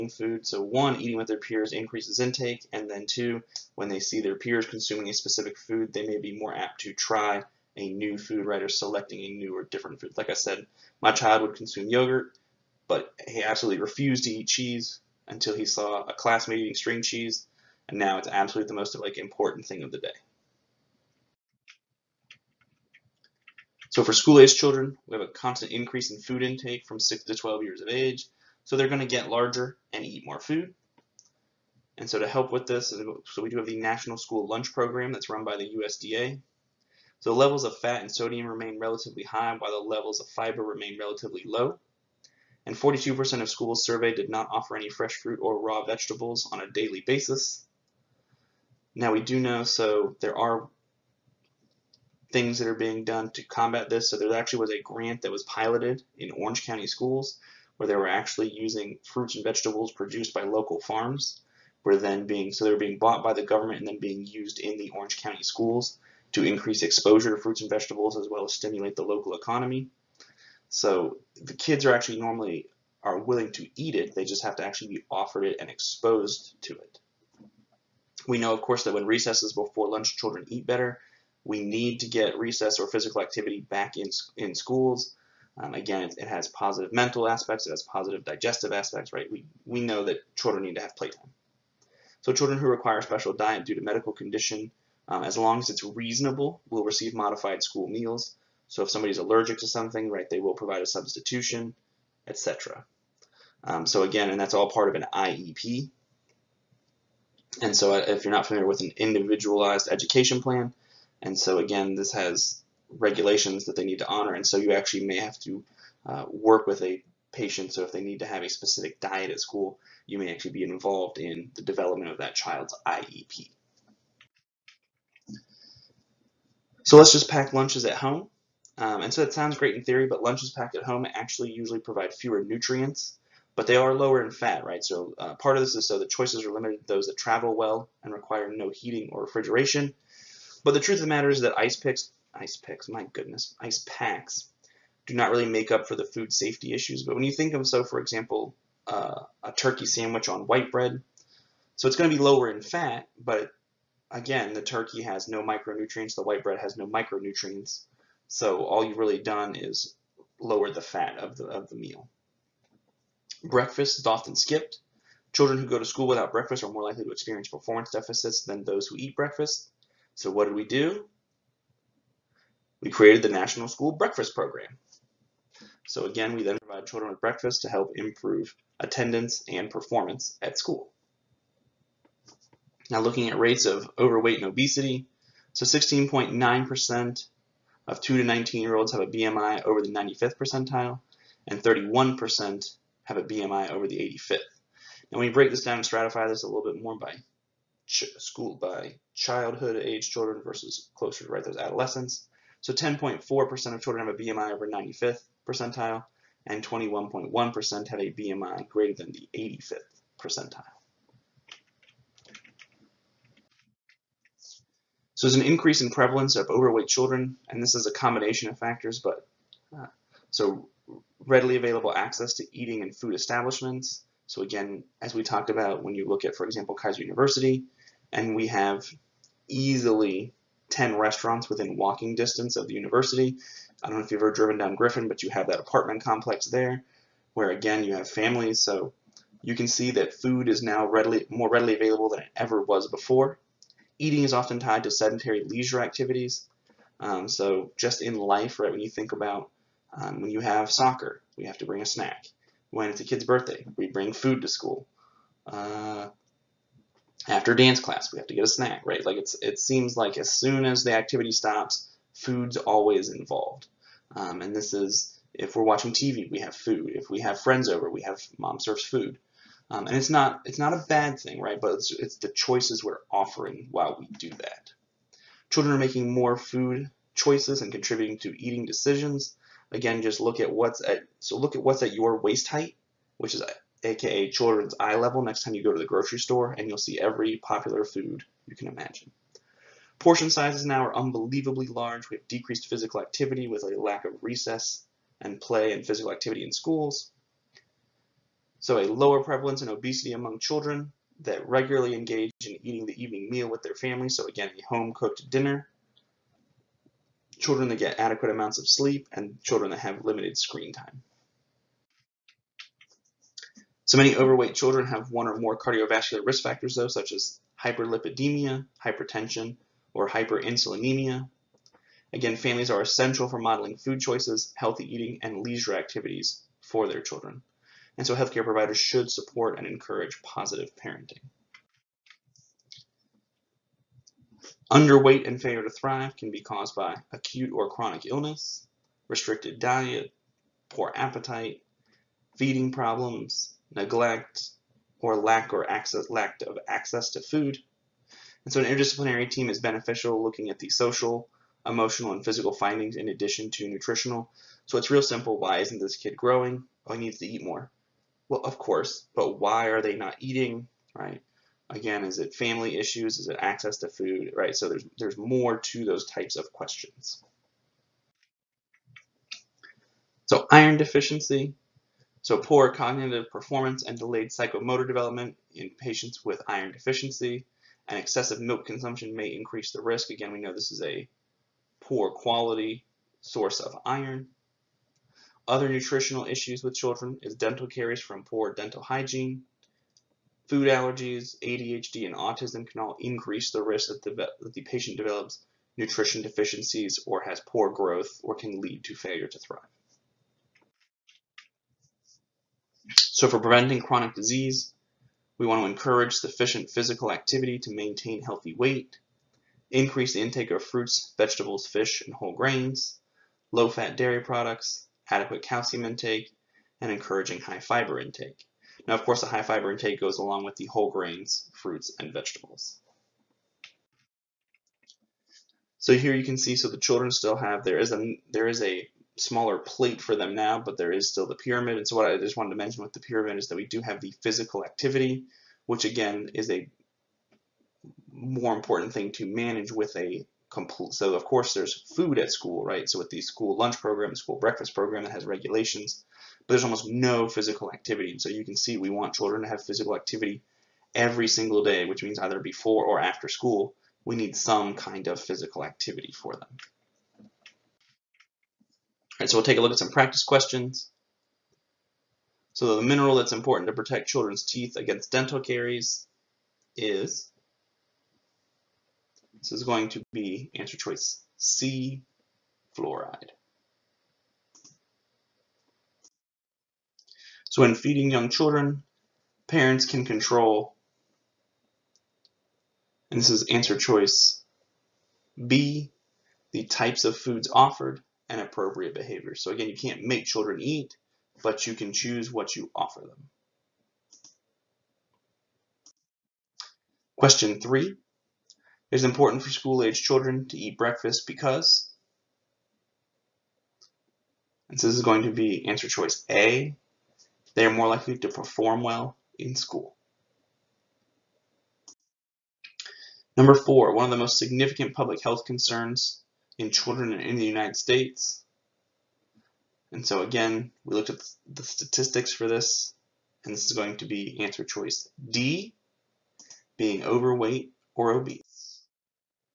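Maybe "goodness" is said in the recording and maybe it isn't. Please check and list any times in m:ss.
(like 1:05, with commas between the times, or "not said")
2:23.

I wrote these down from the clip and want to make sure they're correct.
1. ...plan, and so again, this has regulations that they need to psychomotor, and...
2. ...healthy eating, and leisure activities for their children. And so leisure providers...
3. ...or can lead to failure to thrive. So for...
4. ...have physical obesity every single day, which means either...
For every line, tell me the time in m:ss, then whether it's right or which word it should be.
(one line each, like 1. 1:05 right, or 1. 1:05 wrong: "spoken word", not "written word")
1. 1:50 wrong: "honor", not "psychomotor"
2. 5:24 wrong: "healthcare", not "leisure"
3. 6:38 right
4. 7:29 wrong: "activity", not "obesity".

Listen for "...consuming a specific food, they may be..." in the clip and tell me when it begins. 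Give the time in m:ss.
0:04.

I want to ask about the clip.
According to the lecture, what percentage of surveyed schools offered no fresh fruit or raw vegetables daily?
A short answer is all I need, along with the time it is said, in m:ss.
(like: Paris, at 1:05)
42%, at 0:42.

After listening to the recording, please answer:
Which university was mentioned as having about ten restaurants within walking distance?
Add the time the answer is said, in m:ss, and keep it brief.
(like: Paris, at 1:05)
Keiser University, at 3:46.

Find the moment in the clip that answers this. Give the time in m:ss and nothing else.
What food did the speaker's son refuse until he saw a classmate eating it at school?
0:16.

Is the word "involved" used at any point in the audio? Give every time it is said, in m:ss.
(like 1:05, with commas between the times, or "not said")
2:00, 4:23.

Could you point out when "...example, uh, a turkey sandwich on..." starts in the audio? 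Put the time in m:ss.
2:27.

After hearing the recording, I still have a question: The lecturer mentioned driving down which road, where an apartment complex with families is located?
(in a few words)
Griffin.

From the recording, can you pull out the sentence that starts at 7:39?
Right, so we'll take a look at some practice questions.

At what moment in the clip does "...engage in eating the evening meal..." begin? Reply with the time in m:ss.
5:01.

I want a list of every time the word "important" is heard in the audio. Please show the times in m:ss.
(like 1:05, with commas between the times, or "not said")
0:19, 7:18, 7:43, 8:19.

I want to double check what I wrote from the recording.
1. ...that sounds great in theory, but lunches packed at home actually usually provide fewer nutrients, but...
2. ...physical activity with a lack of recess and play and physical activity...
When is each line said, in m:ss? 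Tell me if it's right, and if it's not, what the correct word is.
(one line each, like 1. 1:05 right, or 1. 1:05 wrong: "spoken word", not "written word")
1. 2:09 right
2. 4:52 right.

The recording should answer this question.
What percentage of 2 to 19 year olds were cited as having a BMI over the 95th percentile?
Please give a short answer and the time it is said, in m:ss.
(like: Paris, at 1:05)
16.9%, at 3:05.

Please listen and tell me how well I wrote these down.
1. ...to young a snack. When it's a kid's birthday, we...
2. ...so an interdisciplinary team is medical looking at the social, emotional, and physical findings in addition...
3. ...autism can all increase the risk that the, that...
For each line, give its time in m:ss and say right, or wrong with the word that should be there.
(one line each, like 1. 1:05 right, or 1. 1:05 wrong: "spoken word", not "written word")
1. 4:11 wrong: "bring", not "young"
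2. 5:48 wrong: "beneficial", not "medical"
3. 6:32 right.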